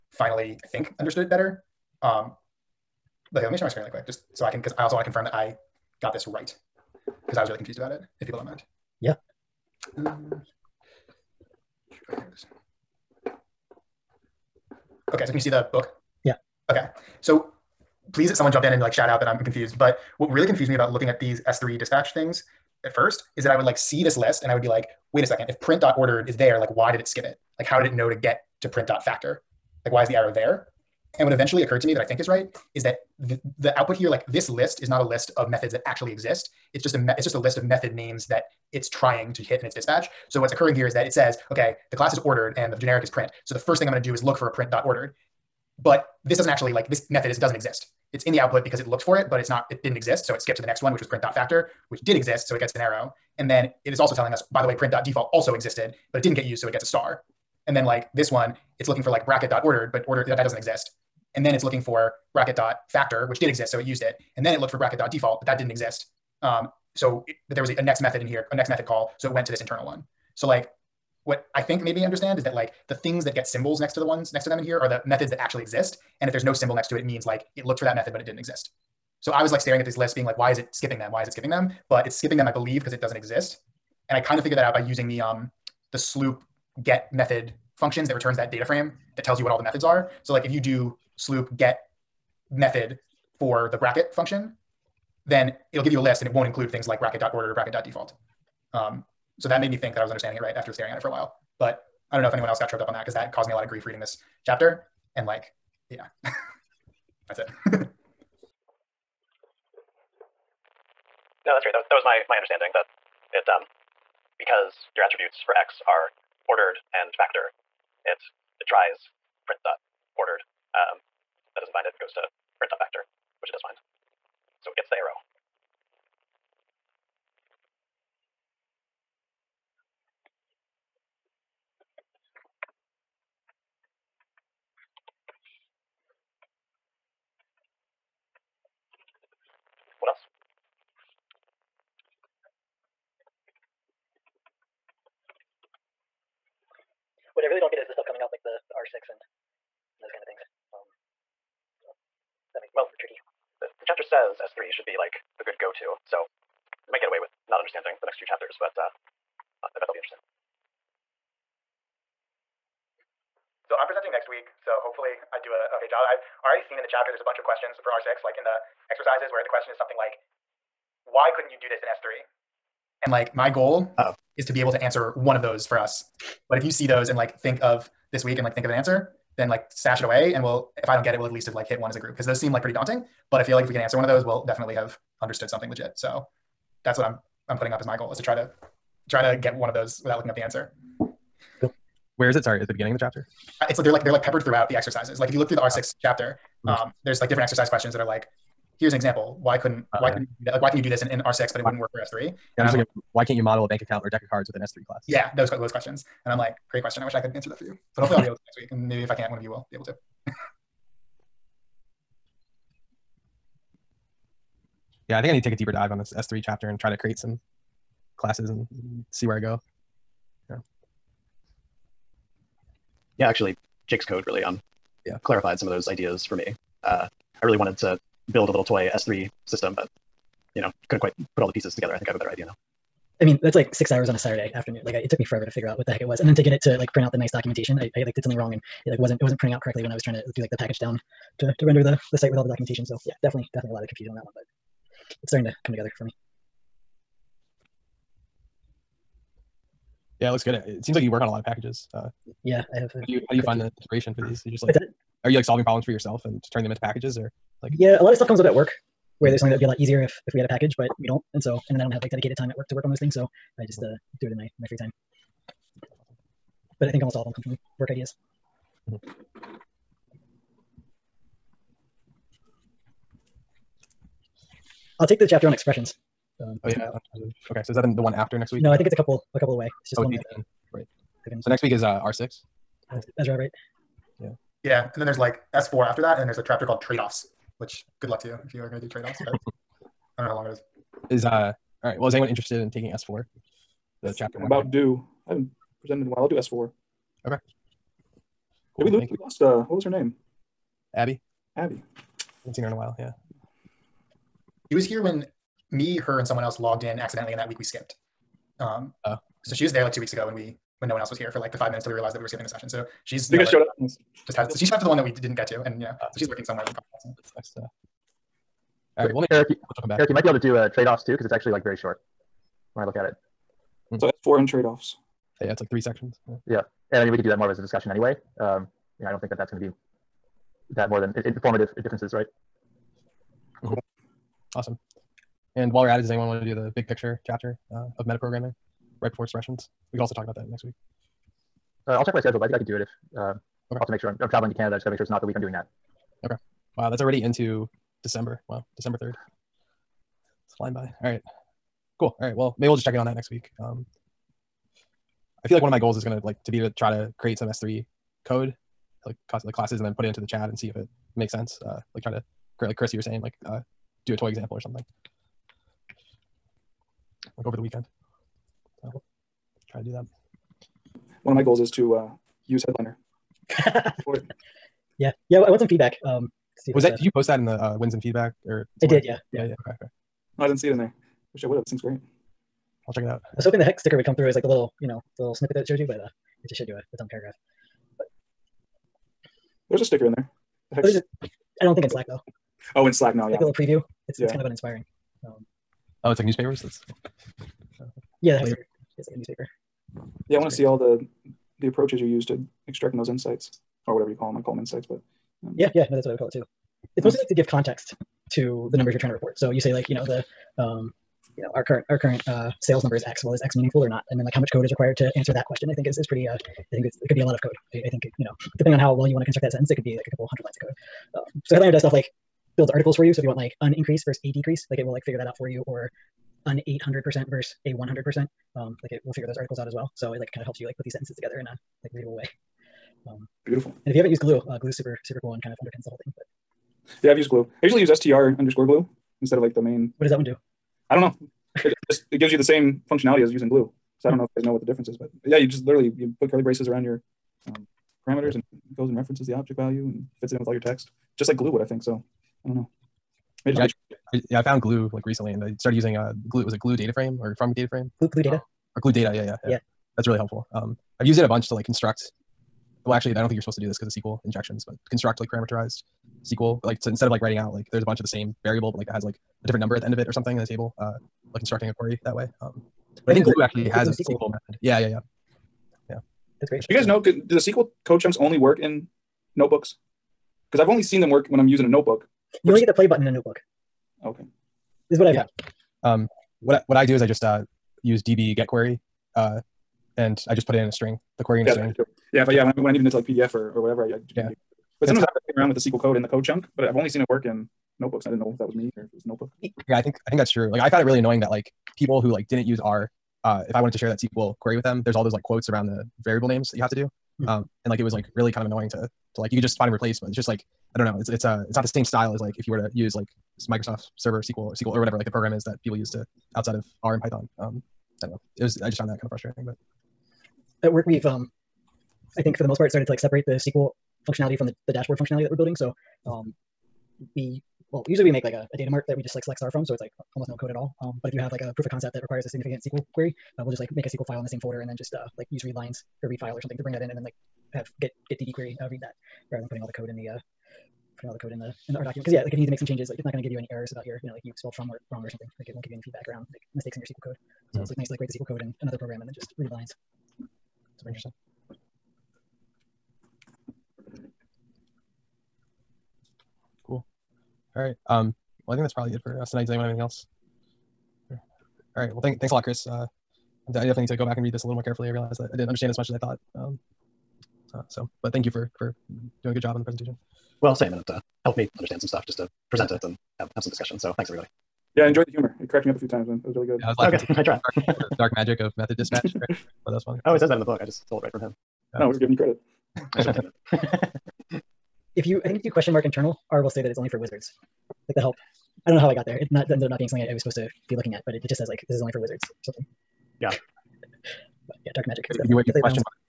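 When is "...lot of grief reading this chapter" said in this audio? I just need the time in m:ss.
1:43.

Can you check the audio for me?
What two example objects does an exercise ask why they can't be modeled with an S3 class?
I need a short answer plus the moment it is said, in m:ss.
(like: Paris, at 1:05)
bank account or deck of cards, at 3:23.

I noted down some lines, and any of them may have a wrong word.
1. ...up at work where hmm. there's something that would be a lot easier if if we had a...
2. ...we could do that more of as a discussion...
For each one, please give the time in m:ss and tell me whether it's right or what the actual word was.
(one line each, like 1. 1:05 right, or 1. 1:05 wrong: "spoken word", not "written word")
1. 4:18 right
2. 5:27 right.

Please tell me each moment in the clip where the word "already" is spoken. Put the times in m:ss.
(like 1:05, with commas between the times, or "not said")
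2:46, 5:46.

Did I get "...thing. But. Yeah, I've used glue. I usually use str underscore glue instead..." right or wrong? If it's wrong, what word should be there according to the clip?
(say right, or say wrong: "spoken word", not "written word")
right.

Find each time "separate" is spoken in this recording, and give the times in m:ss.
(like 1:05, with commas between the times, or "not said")
8:42.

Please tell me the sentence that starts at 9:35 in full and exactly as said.
It cracked me up a few times, and it was really good.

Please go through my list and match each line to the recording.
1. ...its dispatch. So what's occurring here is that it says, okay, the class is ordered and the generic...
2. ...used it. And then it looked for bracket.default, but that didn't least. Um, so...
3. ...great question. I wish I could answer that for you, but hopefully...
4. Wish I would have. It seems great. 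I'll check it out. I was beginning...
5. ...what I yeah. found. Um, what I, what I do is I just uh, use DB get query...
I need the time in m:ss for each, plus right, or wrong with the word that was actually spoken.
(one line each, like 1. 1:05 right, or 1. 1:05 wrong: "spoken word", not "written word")
1. 0:39 right
2. 1:03 wrong: "exist", not "least"
3. 3:26 right
4. 6:21 wrong: "hoping", not "beginning"
5. 8:04 right.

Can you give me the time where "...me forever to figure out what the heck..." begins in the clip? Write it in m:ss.
3:55.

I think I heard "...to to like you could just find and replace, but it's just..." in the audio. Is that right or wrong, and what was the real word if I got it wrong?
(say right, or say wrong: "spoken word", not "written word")
right.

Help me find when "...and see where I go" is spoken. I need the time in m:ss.
3:38.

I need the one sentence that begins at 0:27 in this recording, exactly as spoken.
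Like how did it know to get to print dot factor?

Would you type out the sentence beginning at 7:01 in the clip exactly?
Um, so headliner does stuff like builds articles for you.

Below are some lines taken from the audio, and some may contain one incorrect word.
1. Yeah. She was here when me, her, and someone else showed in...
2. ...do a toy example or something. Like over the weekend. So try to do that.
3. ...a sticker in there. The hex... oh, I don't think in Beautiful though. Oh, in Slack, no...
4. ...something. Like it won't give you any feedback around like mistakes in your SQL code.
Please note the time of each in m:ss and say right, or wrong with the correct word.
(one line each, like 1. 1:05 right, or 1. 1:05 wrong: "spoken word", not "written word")
1. 5:02 wrong: "logged", not "showed"
2. 6:04 right
3. 6:29 wrong: "Slack", not "Beautiful"
4. 9:05 right.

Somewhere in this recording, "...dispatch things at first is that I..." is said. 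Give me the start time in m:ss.
0:21.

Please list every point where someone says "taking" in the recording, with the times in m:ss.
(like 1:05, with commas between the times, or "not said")
4:52.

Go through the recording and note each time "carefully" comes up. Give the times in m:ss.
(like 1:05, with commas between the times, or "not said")
9:24.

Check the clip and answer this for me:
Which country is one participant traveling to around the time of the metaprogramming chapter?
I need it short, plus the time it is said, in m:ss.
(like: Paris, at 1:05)
Canada, at 5:44.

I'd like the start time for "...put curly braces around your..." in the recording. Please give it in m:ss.
7:26.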